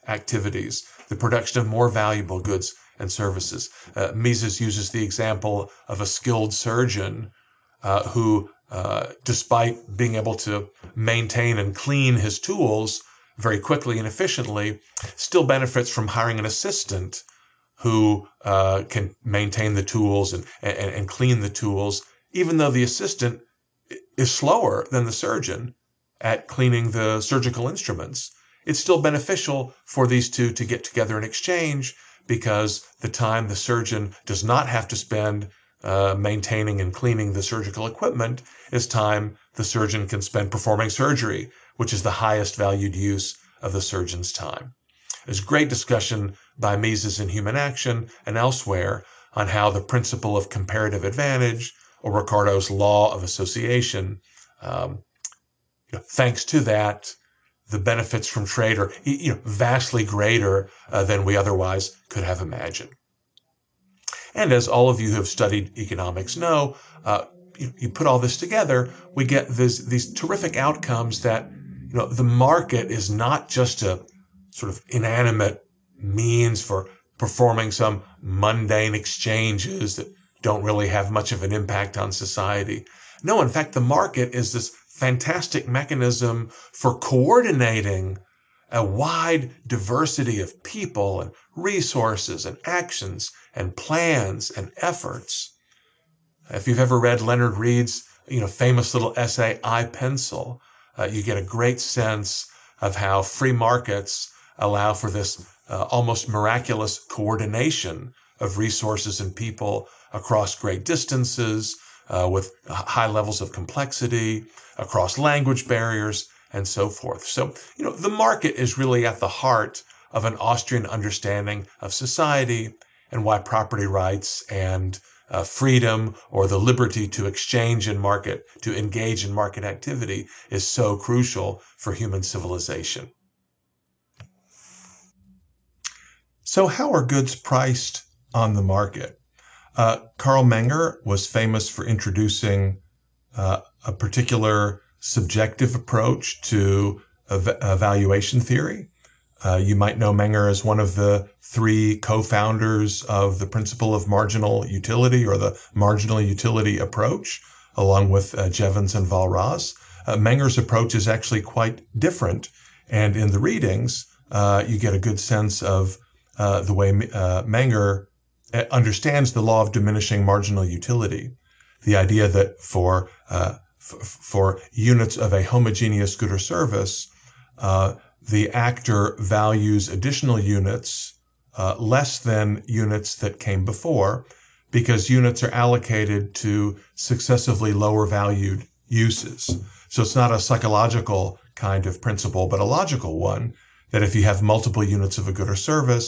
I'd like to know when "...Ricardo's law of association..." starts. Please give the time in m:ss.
0:52.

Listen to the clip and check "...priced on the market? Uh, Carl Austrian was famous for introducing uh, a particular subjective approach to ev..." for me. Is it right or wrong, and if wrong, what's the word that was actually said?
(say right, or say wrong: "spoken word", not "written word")
wrong: "Menger", not "Austrian".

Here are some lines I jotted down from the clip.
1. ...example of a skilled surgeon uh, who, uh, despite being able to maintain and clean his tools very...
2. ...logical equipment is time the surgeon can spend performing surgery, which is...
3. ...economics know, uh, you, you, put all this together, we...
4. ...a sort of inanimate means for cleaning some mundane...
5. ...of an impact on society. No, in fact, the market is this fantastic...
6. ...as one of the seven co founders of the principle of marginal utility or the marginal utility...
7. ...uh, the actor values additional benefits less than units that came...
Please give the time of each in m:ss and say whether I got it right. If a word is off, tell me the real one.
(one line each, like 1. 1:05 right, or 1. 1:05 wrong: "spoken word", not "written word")
1. 0:05 right
2. 0:37 wrong: "surgical", not "logical"
3. 1:05 right
4. 1:13 wrong: "performing", not "cleaning"
5. 1:21 right
6. 2:30 wrong: "three", not "seven"
7. 2:57 wrong: "units", not "benefits".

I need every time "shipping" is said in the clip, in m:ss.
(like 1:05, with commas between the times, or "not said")
not said.